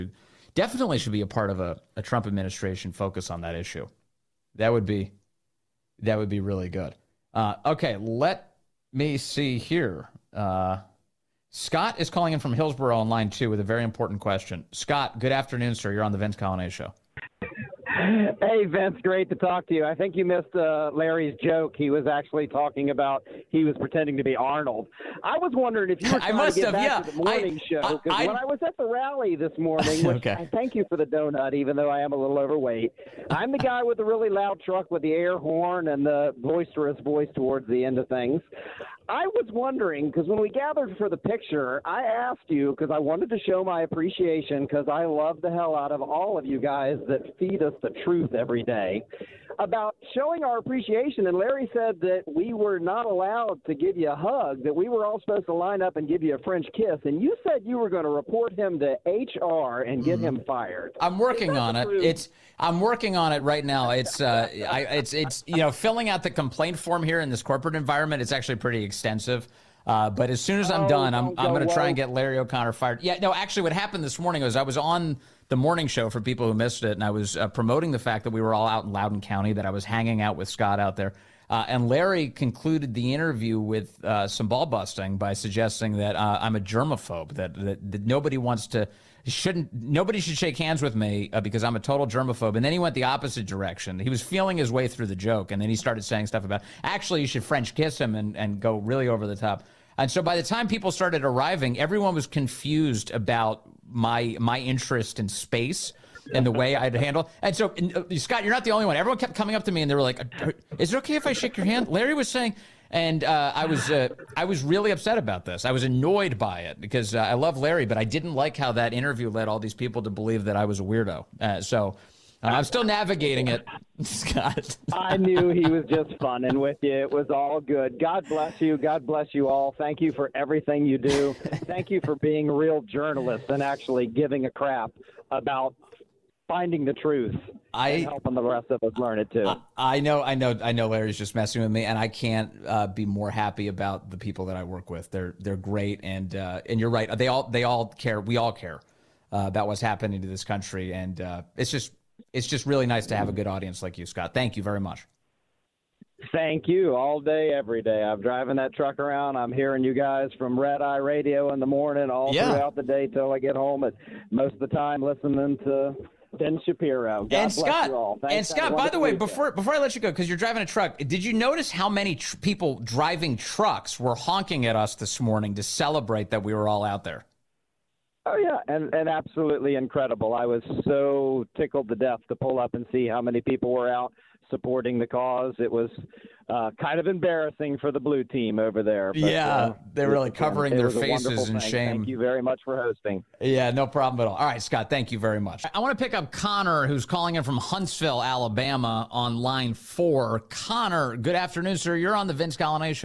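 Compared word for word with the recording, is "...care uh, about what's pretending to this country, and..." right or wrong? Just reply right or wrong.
wrong.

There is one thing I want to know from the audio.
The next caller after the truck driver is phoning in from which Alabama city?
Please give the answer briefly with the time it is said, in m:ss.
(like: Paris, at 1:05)
Huntsville, at 3:17.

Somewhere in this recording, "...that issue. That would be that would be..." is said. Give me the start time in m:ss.
0:03.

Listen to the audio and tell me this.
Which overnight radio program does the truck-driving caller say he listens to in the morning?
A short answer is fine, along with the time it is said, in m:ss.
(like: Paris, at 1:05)
Red Eye Radio, at 2:40.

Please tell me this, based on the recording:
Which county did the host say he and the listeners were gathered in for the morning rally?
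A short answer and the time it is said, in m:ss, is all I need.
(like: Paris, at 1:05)
Loudoun County, at 1:18.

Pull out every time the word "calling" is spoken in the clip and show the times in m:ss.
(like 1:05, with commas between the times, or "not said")
0:12, 3:17.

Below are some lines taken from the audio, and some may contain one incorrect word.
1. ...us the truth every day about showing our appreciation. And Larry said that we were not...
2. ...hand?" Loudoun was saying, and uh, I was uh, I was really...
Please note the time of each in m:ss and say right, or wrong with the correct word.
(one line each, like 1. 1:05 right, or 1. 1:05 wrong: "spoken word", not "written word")
1. 0:47 right
2. 1:51 wrong: "Larry", not "Loudoun".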